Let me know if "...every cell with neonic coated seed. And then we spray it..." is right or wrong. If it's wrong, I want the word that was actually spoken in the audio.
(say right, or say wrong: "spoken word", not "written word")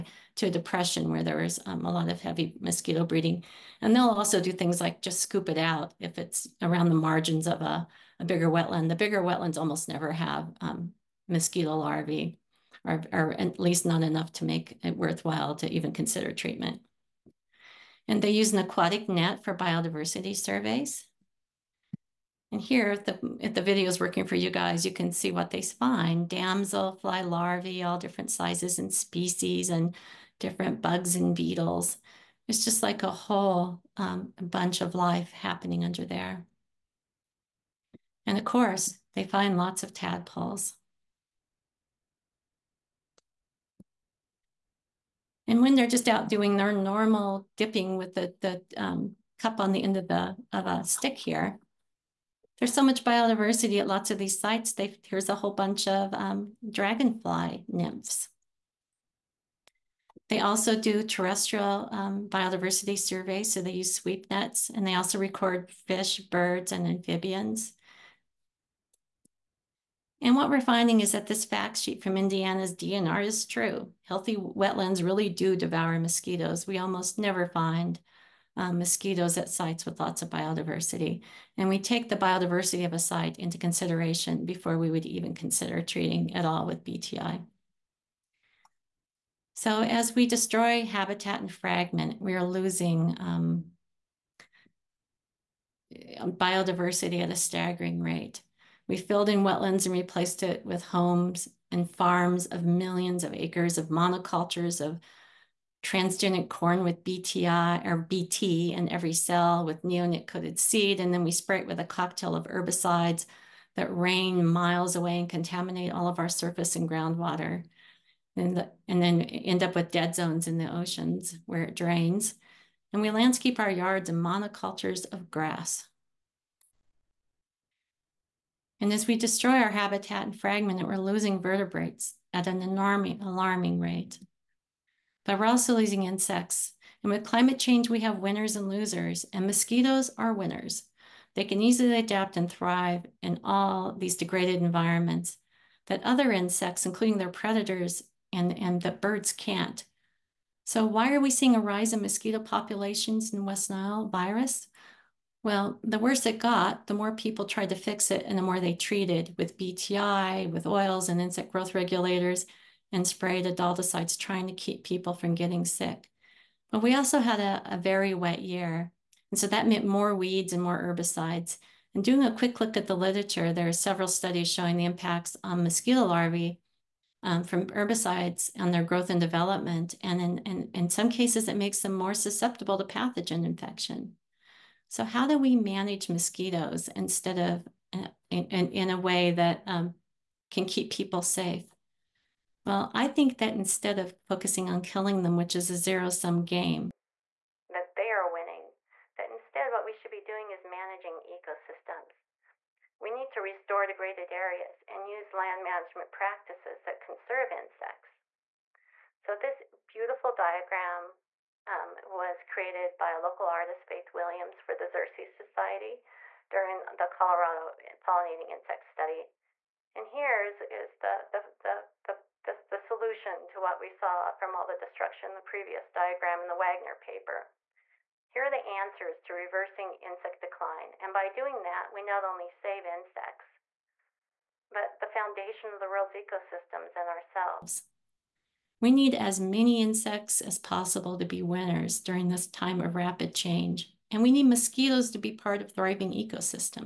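right.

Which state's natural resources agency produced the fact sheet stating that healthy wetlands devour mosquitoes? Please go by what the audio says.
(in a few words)
Indiana.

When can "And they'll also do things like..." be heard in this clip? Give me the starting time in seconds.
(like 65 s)
3 s.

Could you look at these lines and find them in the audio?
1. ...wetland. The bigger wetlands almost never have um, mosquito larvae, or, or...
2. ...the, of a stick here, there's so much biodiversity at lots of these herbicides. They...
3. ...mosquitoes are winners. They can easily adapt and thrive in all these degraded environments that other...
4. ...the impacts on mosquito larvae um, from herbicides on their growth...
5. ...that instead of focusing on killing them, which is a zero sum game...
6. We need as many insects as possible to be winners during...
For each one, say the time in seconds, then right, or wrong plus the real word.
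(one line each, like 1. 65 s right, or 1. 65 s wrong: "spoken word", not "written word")
1. 8 s right
2. 50 s wrong: "sites", not "herbicides"
3. 139 s right
4. 174 s right
5. 193 s right
6. 238 s right.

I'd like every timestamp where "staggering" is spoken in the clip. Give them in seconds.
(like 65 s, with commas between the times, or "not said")
97 s.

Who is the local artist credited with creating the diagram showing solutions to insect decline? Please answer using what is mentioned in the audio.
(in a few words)
Faith Williams.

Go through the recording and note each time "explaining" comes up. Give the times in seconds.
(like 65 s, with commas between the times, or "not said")
not said.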